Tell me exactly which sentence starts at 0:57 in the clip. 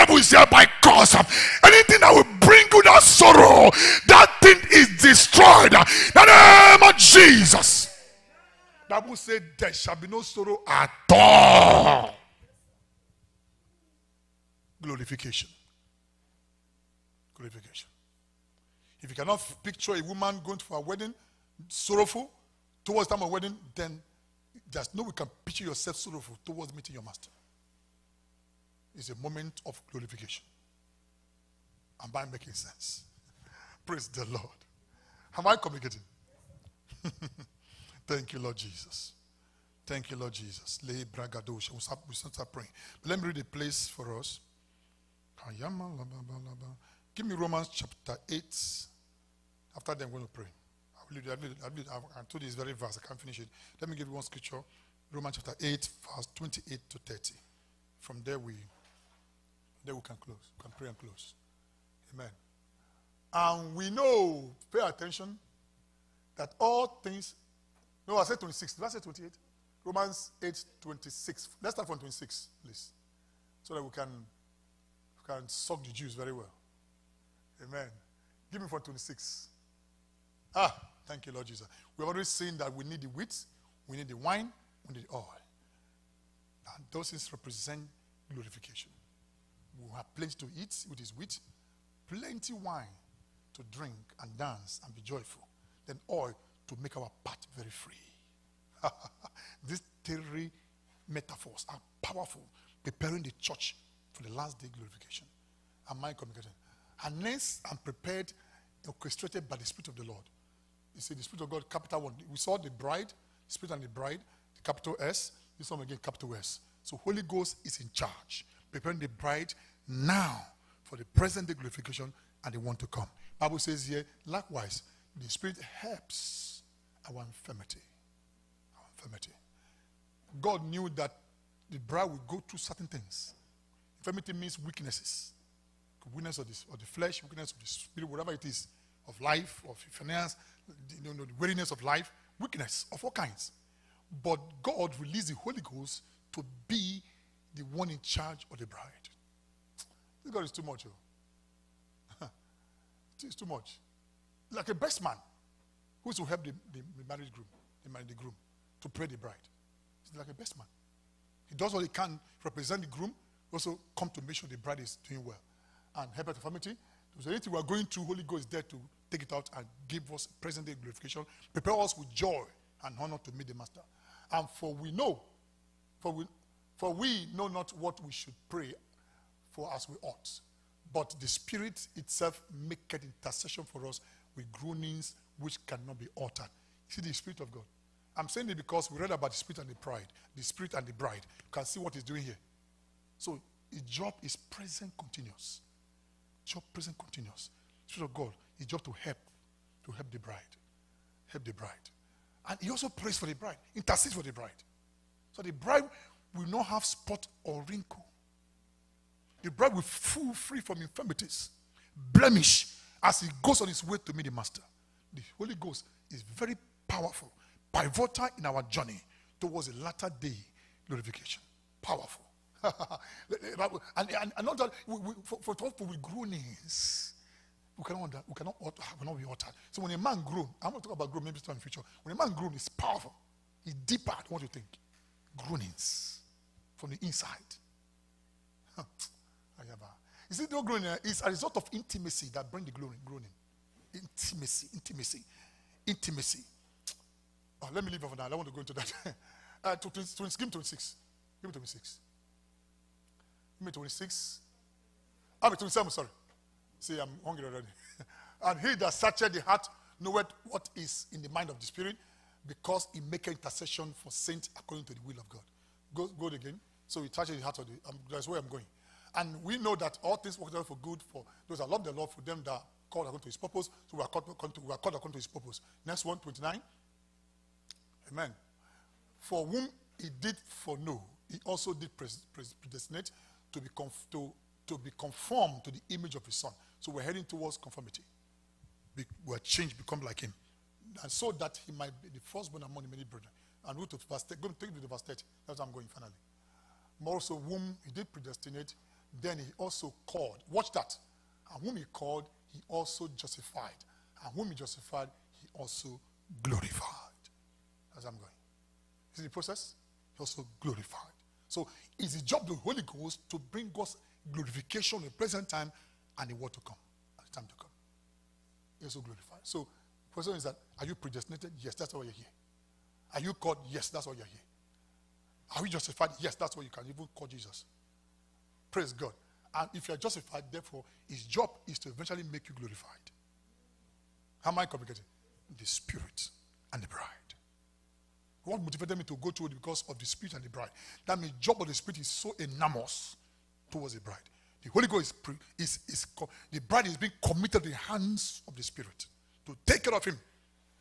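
From there, we, there we can close, we can pray and close.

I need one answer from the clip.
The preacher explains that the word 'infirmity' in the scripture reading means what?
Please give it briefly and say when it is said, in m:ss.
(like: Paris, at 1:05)
Weaknesses, at 2:14.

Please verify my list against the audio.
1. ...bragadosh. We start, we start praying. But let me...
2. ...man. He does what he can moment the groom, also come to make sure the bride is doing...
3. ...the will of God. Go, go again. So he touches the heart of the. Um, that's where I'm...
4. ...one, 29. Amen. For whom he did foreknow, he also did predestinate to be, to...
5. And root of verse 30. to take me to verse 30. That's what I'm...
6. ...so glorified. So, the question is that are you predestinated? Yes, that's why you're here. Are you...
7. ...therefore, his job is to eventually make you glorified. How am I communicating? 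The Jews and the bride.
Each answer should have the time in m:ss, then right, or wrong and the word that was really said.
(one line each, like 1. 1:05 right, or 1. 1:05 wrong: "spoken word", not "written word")
1. 0:41 right
2. 2:40 wrong: "represent", not "moment"
3. 4:24 right
4. 4:36 right
5. 4:53 right
6. 5:18 right
7. 5:30 wrong: "Spirit", not "Jews".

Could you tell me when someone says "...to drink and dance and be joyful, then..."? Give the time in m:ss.
1:33.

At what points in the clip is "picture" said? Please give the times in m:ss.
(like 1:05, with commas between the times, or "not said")
0:19, 0:25.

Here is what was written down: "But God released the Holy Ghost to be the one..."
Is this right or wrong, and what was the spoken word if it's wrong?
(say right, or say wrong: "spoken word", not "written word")
right.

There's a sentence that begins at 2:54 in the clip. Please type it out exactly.
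And for we know, for we, for we know not what we should pray for as we ought.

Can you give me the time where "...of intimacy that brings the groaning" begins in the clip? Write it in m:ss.
4:01.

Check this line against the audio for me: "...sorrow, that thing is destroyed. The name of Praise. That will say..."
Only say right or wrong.
wrong.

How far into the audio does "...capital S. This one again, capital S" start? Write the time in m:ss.
1:54.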